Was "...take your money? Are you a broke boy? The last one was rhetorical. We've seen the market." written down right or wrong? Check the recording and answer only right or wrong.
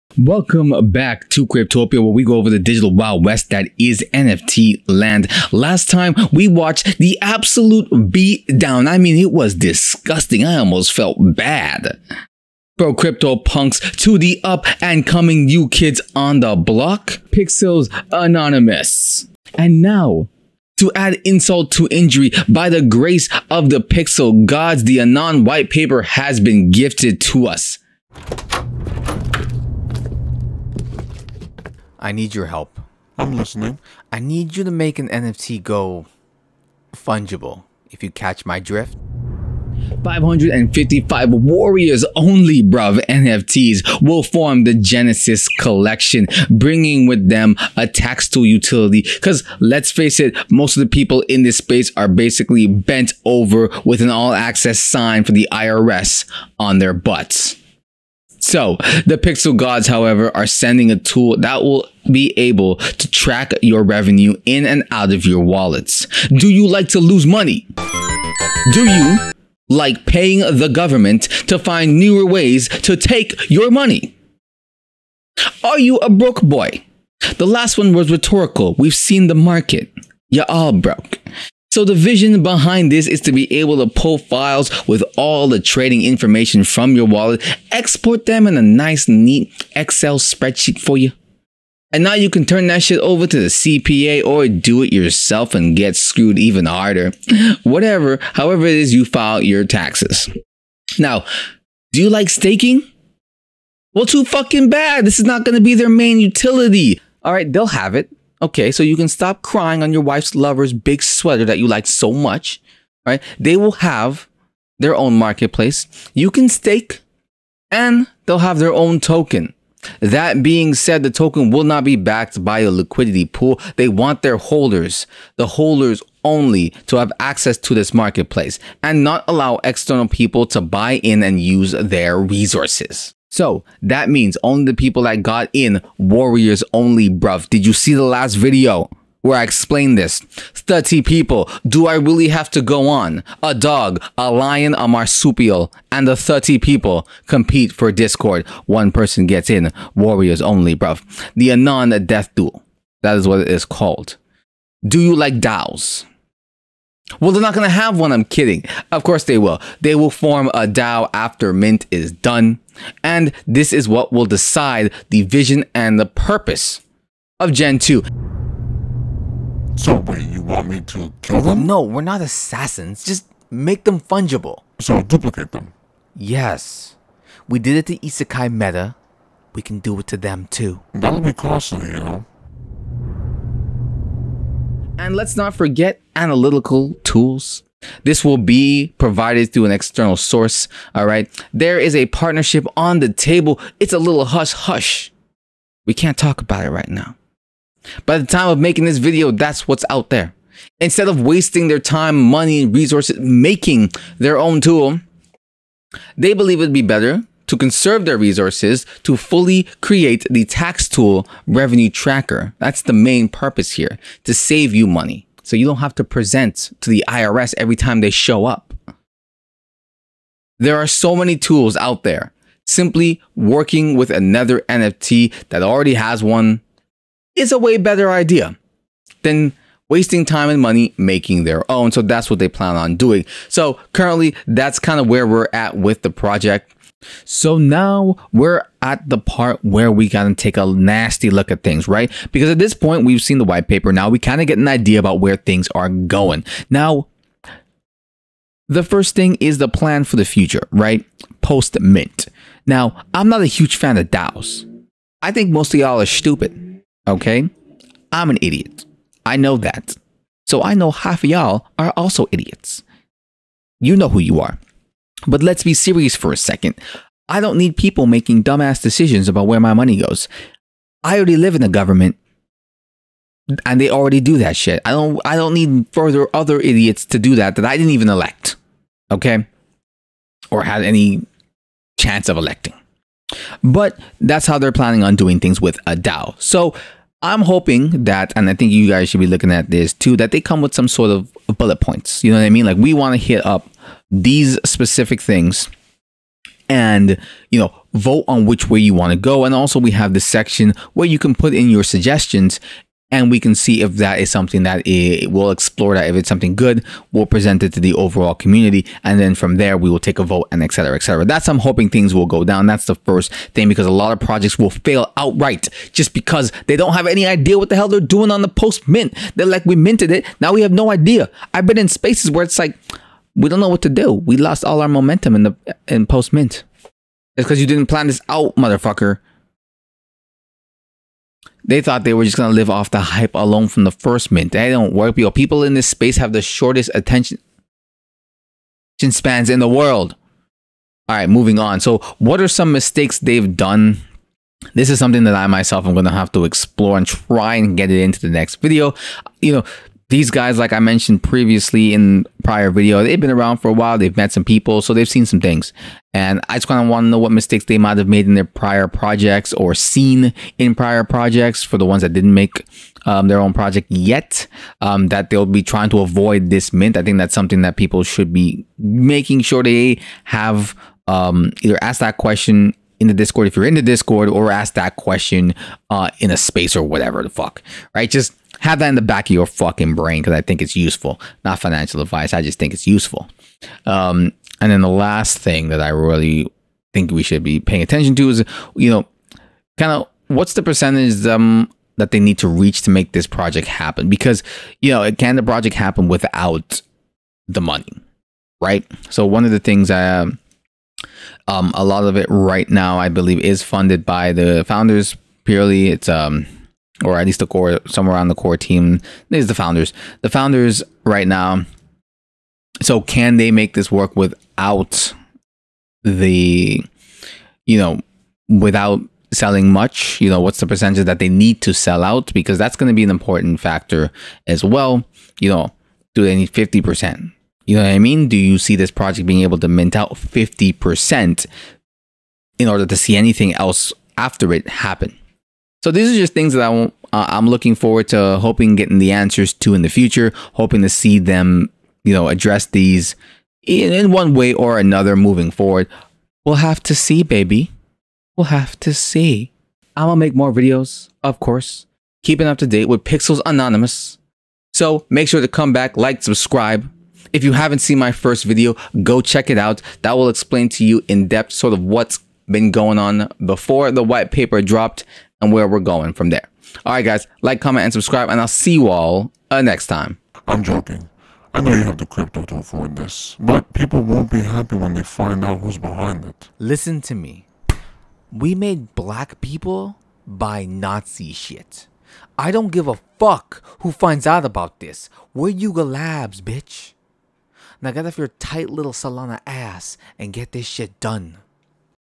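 right.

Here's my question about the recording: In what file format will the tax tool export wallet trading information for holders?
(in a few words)
Excel spreadsheet.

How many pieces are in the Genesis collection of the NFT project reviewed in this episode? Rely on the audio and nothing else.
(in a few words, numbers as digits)
555.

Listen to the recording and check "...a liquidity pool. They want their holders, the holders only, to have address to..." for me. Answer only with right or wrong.
wrong.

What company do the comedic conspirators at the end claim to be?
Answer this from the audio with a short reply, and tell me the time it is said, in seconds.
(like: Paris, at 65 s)
Yuga Labs, at 485 s.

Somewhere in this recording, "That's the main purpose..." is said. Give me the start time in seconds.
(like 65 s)
212 s.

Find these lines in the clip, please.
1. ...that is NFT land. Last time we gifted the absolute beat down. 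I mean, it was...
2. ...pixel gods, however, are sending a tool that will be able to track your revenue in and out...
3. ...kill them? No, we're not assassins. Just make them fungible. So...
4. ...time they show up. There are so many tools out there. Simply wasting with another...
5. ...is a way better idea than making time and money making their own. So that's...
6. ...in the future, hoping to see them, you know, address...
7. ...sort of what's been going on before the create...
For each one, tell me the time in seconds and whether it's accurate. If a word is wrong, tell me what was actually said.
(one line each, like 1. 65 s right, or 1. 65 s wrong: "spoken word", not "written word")
1. 3 s wrong: "watched", not "gifted"
2. 59 s right
3. 171 s right
4. 217 s wrong: "working", not "wasting"
5. 227 s wrong: "wasting", not "making"
6. 439 s right
7. 461 s wrong: "white", not "create".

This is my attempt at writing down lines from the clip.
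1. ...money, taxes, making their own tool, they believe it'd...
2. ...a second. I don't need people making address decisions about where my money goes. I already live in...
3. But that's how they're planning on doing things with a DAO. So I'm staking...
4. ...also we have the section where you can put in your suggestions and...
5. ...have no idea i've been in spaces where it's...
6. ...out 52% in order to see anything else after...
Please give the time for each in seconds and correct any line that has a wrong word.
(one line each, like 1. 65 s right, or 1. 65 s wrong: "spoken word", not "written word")
1. 202 s wrong: "resources", not "taxes"
2. 266 s wrong: "dumbass", not "address"
3. 283 s wrong: "hoping", not "staking"
4. 299 s right
5. 320 s right
6. 429 s wrong: "50", not "52".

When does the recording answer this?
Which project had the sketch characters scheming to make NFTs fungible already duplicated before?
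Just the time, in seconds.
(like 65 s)
177 s.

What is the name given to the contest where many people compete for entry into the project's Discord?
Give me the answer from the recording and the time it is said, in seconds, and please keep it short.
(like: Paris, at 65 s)
The Anon Death Duel, at 151 s.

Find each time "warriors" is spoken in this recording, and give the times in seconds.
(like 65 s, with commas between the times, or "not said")
41 s, 135 s, 149 s.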